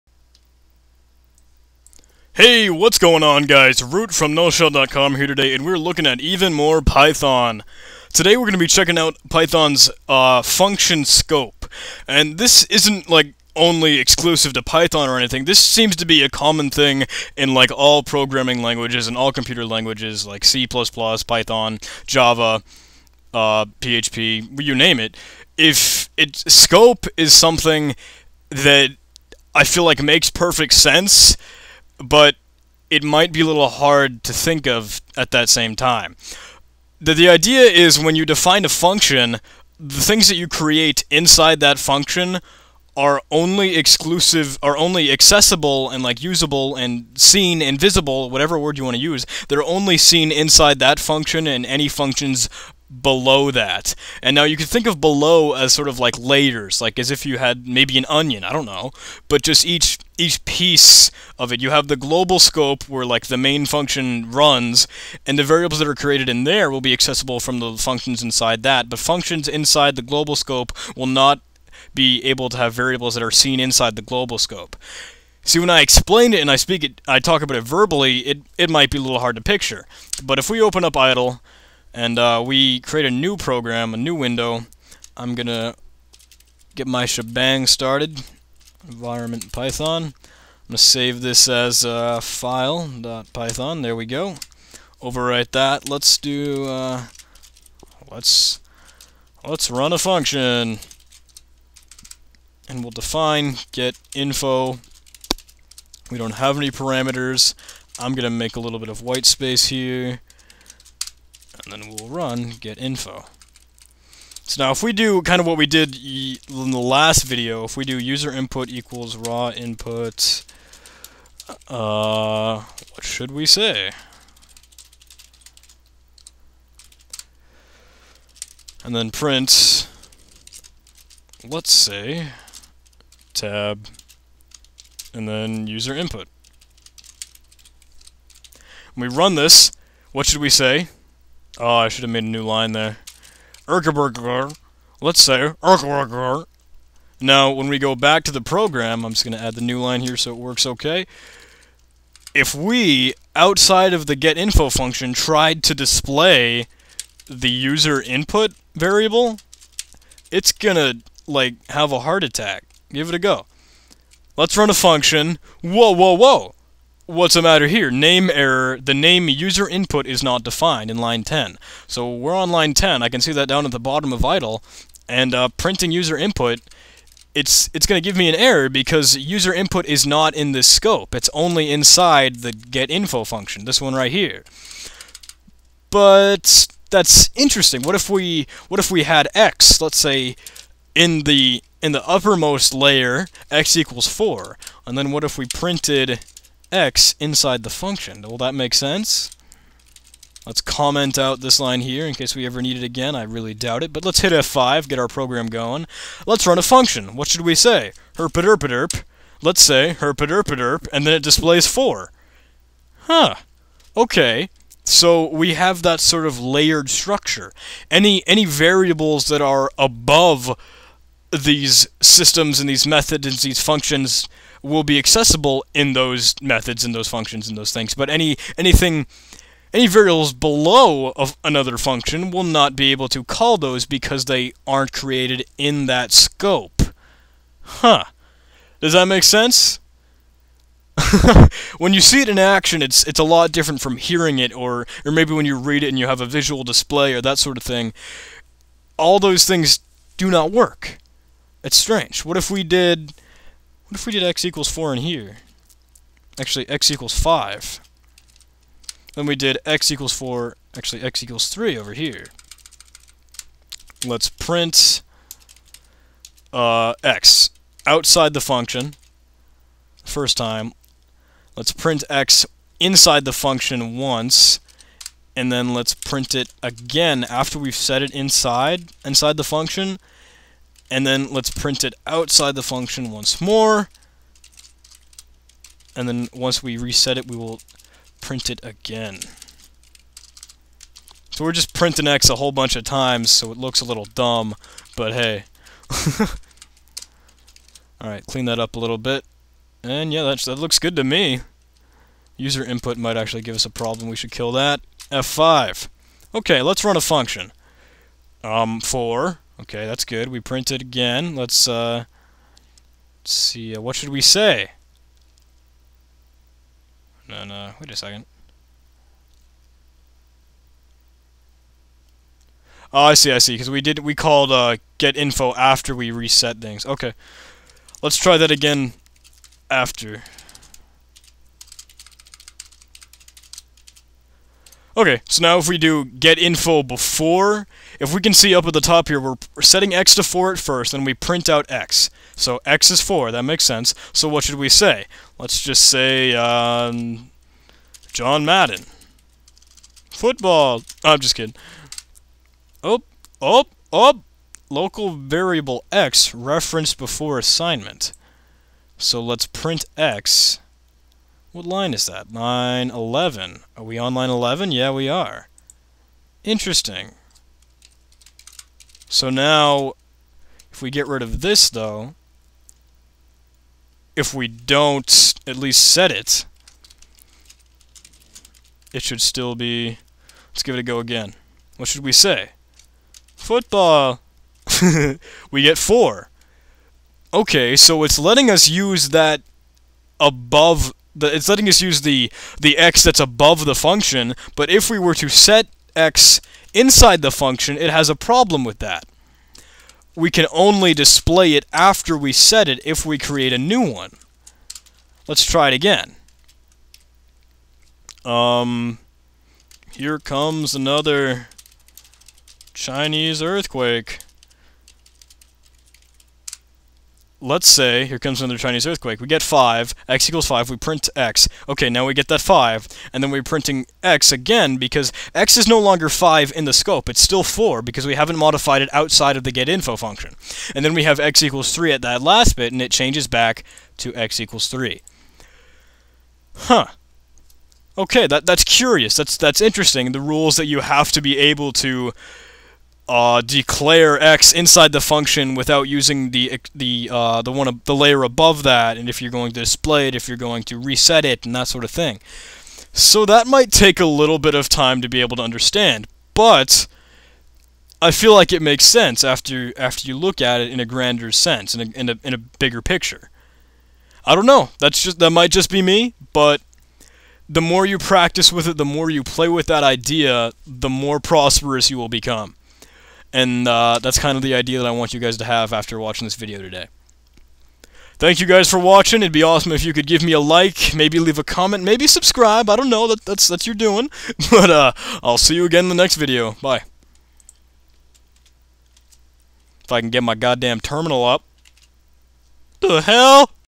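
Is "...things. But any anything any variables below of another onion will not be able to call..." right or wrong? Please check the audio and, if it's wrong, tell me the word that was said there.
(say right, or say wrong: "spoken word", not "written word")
wrong: "function", not "onion".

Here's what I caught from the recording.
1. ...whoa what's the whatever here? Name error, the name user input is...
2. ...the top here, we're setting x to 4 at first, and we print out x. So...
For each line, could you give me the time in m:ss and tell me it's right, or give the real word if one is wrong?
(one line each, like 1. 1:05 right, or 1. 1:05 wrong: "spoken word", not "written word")
1. 2:46 wrong: "matter", not "whatever"
2. 5:38 right.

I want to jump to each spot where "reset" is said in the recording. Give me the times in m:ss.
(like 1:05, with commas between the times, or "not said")
4:46, 5:26, 7:30.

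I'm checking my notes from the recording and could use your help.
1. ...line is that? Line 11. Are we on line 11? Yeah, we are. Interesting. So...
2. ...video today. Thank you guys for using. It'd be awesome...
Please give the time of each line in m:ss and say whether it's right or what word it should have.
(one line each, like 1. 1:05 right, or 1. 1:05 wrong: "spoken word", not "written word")
1. 6:01 right
2. 7:56 wrong: "watching", not "using".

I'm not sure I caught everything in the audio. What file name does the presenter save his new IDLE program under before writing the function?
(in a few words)
file.python.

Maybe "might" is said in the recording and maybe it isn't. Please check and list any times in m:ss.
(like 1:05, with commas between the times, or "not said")
0:33, 1:18, 5:02, 7:33, 7:45.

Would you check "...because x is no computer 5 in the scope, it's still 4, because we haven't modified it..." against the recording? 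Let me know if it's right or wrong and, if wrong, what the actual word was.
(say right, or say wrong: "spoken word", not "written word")
wrong: "longer", not "computer".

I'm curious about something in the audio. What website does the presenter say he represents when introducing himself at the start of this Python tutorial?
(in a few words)
NullShell.com.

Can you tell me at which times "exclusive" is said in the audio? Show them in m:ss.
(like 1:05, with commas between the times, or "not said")
0:13, 0:43.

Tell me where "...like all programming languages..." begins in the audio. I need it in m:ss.
0:17.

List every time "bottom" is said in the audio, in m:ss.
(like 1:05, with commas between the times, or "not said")
2:53.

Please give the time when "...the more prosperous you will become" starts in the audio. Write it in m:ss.
7:50.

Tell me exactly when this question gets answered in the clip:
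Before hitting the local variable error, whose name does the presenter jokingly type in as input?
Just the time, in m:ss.
5:48.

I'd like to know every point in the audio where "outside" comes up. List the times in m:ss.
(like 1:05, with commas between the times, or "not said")
2:33, 4:27, 4:42, 7:08.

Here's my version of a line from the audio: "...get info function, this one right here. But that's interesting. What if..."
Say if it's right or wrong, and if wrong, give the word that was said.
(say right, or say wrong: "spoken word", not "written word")
right.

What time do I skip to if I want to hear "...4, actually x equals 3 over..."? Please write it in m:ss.
4:20.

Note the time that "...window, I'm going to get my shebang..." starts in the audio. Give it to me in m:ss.
1:24.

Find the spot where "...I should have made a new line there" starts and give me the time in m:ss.
2:21.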